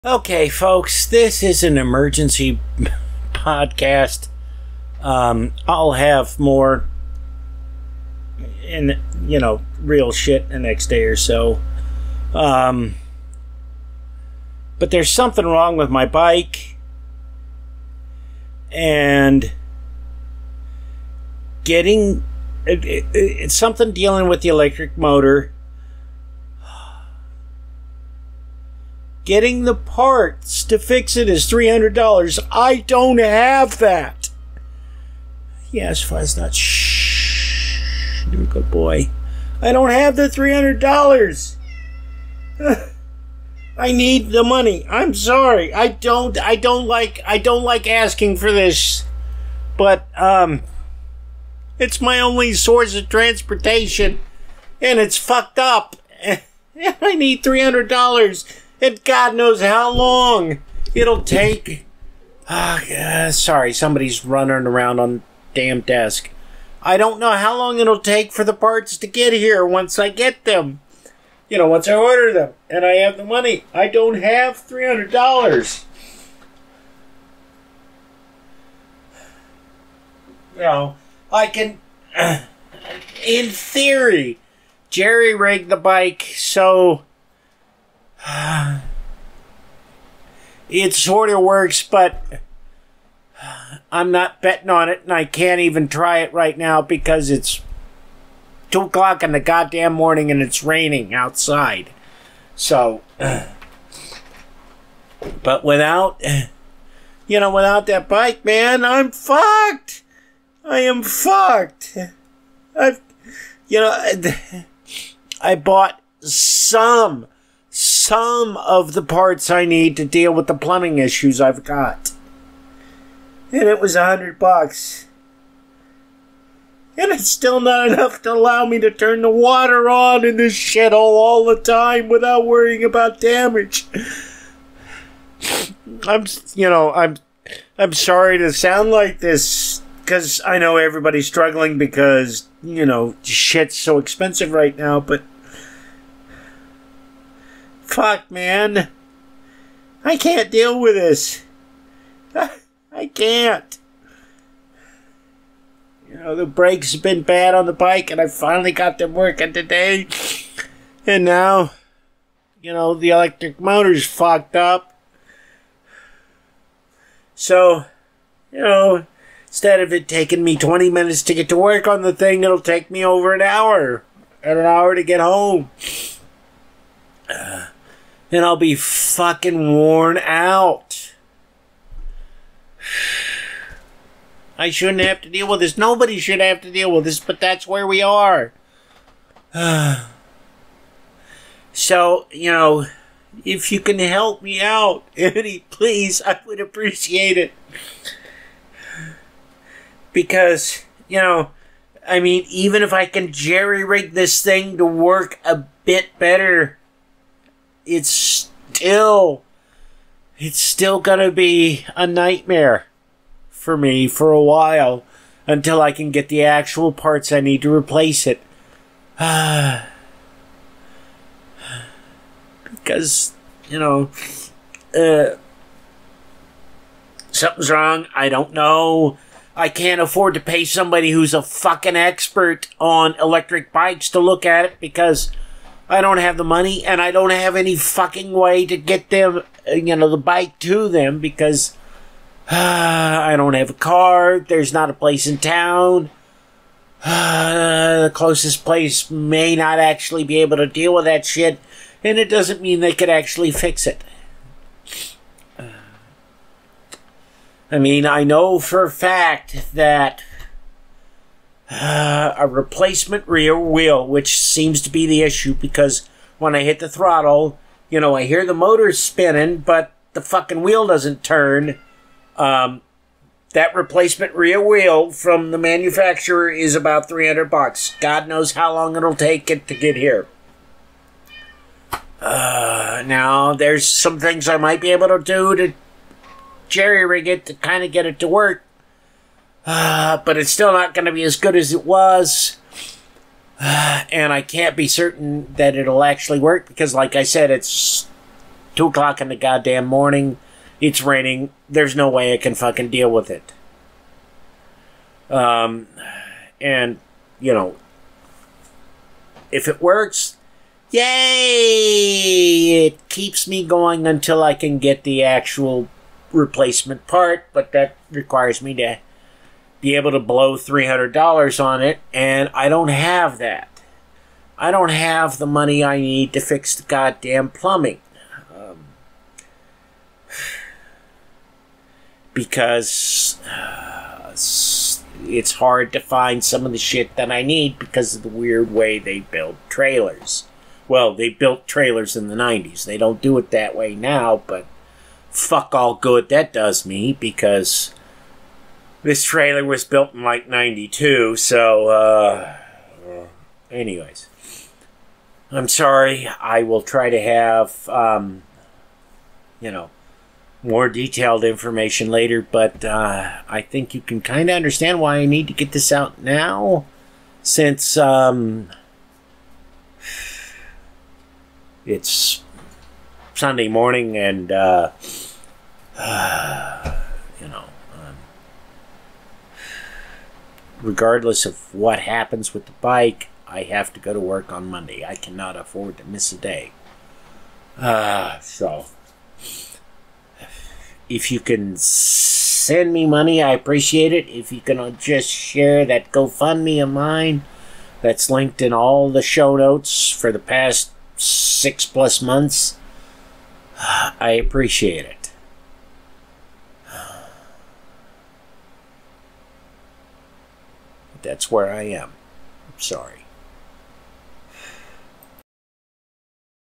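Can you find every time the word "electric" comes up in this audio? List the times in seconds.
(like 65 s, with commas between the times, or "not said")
24 s, 163 s, 233 s.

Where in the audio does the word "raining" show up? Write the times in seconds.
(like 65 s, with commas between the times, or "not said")
100 s, 301 s.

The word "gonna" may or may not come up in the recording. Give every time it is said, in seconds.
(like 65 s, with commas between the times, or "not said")
210 s.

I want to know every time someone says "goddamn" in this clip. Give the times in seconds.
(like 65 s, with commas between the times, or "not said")
99 s, 299 s, 326 s.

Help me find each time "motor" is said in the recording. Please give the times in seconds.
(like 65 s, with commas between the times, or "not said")
24 s, 163 s, 268 s.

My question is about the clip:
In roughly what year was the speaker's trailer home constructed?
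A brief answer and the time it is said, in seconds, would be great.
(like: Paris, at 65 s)
1992, at 350 s.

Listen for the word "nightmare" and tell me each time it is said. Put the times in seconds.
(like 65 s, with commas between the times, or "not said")
212 s.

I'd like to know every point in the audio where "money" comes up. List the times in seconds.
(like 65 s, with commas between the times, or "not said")
44 s, 73 s, 236 s, 325 s, 393 s.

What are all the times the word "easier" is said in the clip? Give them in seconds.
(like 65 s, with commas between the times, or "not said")
not said.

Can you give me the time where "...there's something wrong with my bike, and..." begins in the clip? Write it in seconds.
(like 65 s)
14 s.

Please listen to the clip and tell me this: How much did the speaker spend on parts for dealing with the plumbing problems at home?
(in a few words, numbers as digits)
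$100.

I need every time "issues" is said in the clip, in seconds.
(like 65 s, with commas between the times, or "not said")
120 s, 265 s.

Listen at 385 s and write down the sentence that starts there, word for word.
I cannot afford to miss a day.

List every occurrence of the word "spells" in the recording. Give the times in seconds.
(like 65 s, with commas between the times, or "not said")
not said.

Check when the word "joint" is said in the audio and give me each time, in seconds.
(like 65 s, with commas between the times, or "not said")
not said.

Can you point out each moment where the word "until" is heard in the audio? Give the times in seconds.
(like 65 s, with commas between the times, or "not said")
215 s, 314 s.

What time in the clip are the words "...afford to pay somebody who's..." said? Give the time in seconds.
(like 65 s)
229 s.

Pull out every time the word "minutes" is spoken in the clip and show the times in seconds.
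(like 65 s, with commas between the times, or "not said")
170 s.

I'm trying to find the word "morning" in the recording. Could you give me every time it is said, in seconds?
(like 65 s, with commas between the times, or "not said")
99 s, 299 s, 373 s.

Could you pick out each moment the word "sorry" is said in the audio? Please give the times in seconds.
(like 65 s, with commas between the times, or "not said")
45 s, 63 s, 137 s, 355 s, 412 s.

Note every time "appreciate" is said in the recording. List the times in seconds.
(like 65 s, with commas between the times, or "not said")
196 s, 393 s, 404 s.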